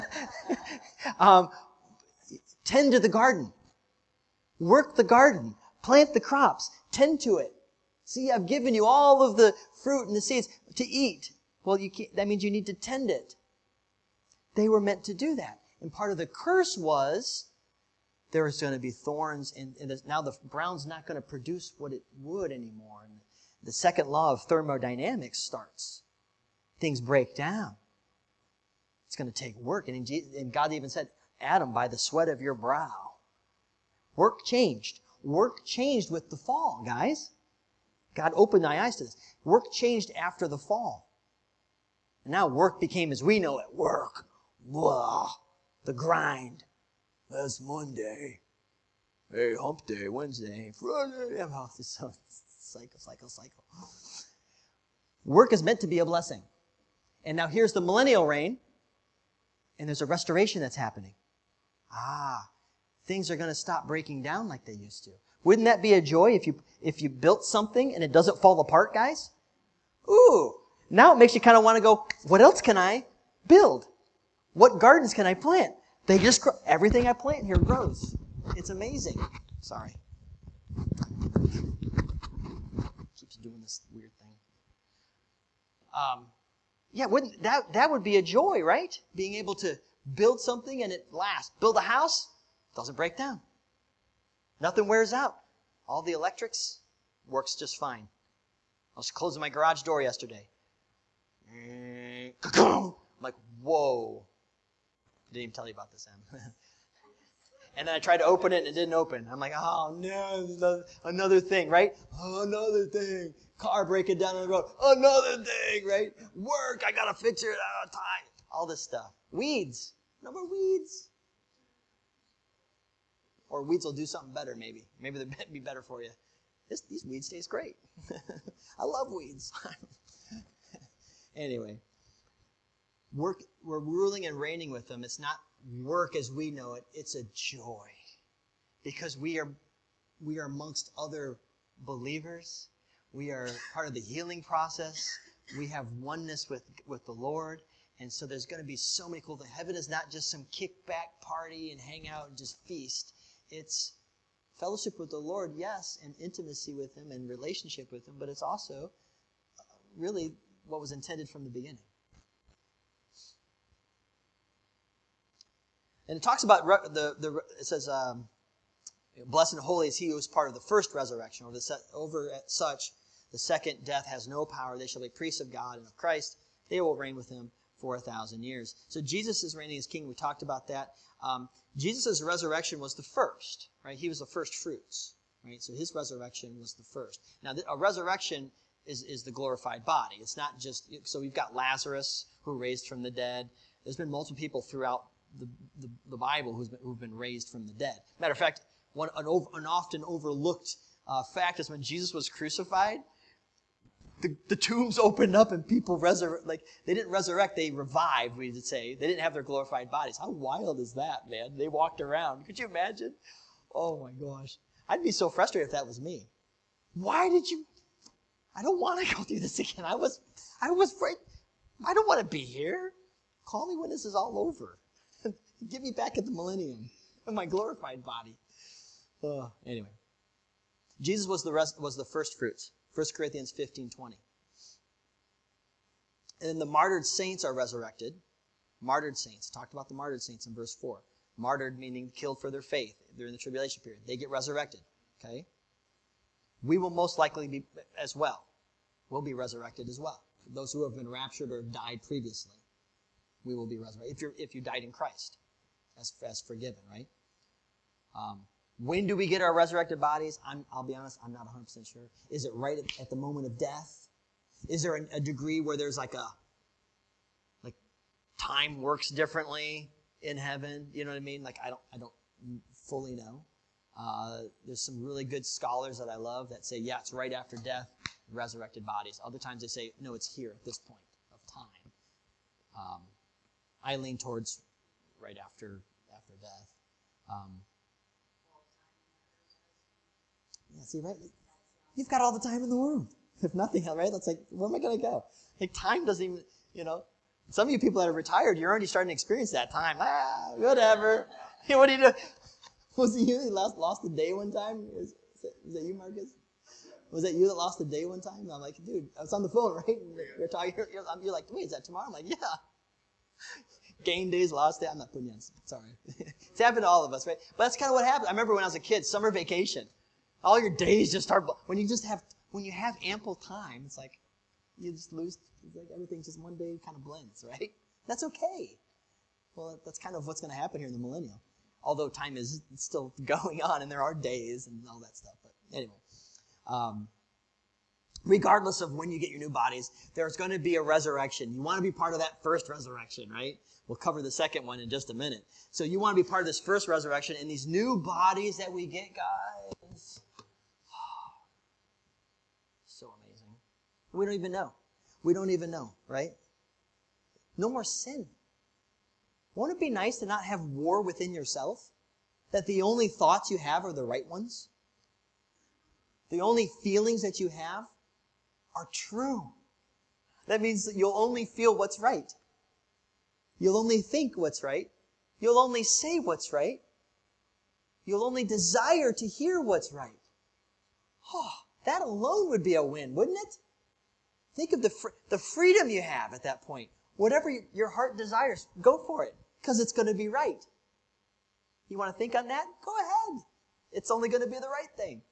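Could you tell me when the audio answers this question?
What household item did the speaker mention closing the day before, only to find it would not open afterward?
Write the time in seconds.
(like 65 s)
99 s.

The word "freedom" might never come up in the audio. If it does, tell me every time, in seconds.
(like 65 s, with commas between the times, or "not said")
385 s.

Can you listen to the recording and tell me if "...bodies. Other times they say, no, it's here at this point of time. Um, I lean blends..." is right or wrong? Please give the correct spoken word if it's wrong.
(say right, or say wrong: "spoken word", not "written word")
wrong: "towards", not "blends".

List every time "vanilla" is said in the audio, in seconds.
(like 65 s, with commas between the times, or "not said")
not said.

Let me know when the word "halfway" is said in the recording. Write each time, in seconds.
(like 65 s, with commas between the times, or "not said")
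not said.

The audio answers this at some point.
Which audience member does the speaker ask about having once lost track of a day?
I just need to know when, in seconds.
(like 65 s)
305 s.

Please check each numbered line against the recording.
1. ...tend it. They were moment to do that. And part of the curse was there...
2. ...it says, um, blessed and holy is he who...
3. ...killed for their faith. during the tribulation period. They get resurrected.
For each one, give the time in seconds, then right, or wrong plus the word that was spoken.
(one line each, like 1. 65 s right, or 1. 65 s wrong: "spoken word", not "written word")
1. 12 s wrong: "meant", not "moment"
2. 167 s right
3. 242 s right.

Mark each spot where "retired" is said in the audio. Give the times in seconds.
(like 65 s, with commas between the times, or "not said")
298 s.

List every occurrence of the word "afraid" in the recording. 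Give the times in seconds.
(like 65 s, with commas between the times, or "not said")
220 s.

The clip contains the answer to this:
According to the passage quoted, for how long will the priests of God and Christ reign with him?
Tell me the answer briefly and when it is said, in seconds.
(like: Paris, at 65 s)
1000 years, at 177 s.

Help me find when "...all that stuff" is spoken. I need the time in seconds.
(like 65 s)
334 s.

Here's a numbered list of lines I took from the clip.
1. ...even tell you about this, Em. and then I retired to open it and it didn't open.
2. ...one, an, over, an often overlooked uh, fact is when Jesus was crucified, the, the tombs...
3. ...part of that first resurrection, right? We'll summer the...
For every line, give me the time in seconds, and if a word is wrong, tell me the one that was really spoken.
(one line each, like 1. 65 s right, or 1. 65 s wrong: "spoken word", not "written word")
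1. 105 s wrong: "tried", not "retired"
2. 198 s right
3. 341 s wrong: "cover", not "summer".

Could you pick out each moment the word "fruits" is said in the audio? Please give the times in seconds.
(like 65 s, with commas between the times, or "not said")
9 s, 184 s, 232 s.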